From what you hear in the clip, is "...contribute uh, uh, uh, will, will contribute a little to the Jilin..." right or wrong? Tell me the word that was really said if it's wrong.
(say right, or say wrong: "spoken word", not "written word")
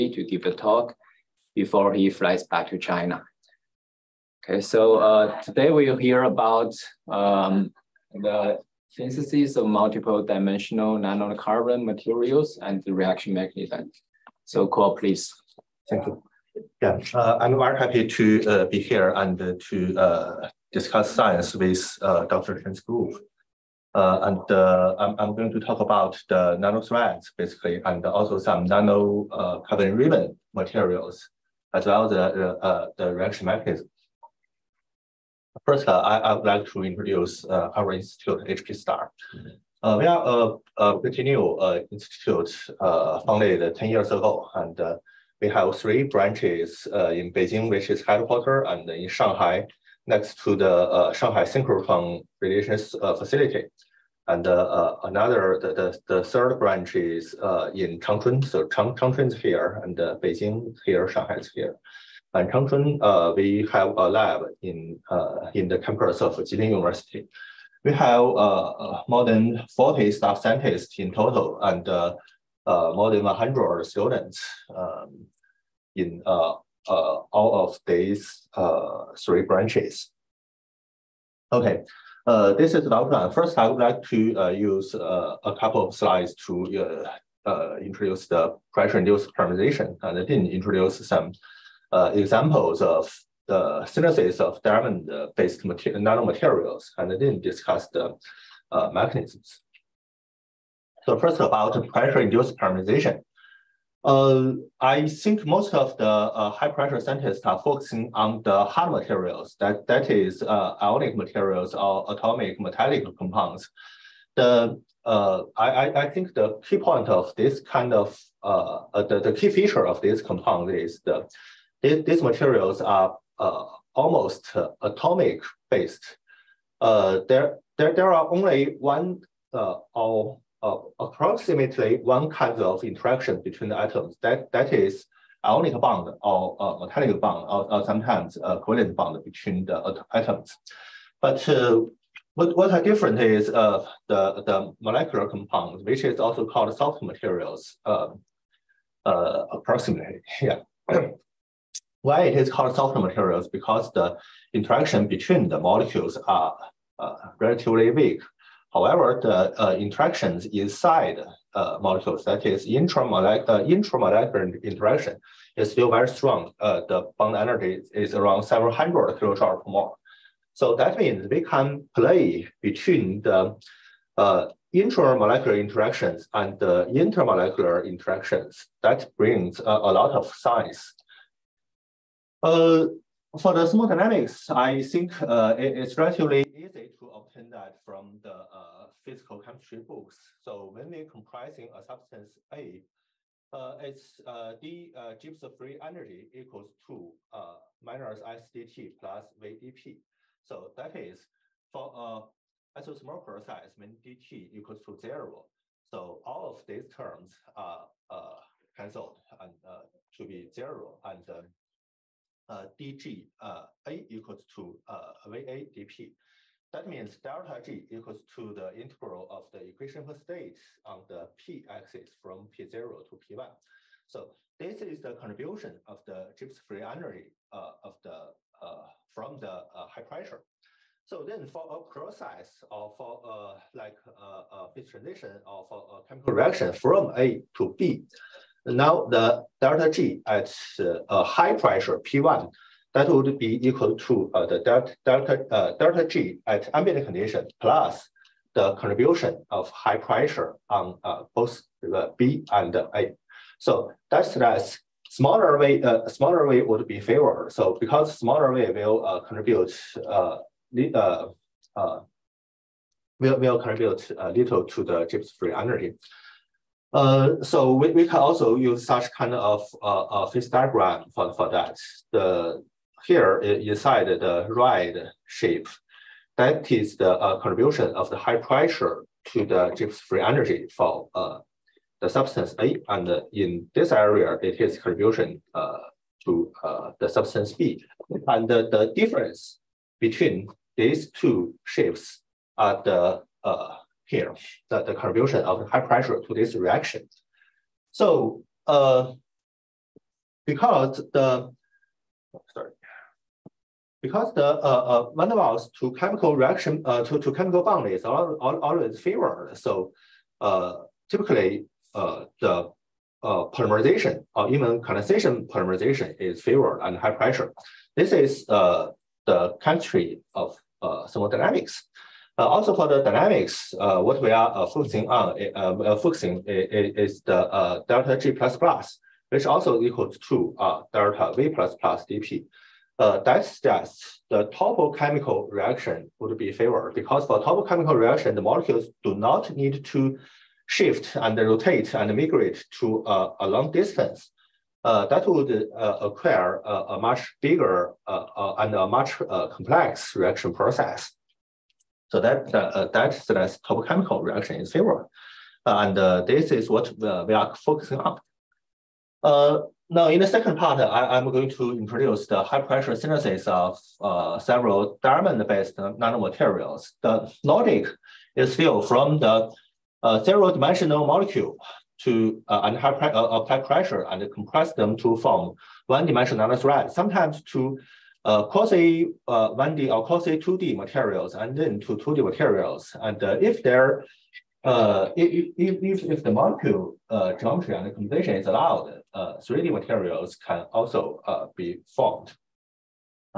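wrong: "Gibbs", not "Jilin".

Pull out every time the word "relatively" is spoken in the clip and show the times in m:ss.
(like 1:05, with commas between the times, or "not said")
2:37, 3:05.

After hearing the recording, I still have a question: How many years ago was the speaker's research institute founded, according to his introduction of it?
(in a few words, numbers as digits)
10.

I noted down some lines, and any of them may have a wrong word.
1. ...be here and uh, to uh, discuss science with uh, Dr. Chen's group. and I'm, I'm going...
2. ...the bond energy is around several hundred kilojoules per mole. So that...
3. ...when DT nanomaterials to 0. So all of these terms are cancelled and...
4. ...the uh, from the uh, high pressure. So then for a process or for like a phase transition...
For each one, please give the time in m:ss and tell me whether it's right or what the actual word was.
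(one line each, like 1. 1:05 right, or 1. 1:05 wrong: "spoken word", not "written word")
1. 0:18 right
2. 2:46 right
3. 3:23 wrong: "equals", not "nanomaterials"
4. 3:48 right.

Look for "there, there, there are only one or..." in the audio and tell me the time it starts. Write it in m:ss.
2:06.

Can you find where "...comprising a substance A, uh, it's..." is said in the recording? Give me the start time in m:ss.
3:11.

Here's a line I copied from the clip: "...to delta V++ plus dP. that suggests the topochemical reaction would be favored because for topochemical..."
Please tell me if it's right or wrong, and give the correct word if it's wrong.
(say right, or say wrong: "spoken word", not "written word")
right.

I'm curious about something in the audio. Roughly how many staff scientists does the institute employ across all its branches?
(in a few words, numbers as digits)
more than 40.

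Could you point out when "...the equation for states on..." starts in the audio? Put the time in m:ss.
3:39.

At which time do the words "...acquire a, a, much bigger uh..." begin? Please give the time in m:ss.
5:46.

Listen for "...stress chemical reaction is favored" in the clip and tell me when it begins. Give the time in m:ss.
5:53.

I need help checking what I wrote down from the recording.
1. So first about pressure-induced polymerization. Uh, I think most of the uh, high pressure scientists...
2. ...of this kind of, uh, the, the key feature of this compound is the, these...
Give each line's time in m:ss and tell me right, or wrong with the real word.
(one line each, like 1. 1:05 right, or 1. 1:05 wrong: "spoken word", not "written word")
1. 1:41 right
2. 1:57 right.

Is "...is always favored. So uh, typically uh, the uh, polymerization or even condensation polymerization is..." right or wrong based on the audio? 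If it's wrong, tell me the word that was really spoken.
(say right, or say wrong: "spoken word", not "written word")
right.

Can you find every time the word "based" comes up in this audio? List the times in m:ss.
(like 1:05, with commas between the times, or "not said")
1:34, 2:05, 6:05.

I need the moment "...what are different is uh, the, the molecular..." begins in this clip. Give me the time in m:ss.
2:22.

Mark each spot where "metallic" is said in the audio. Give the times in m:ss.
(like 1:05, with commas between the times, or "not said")
1:52, 2:16.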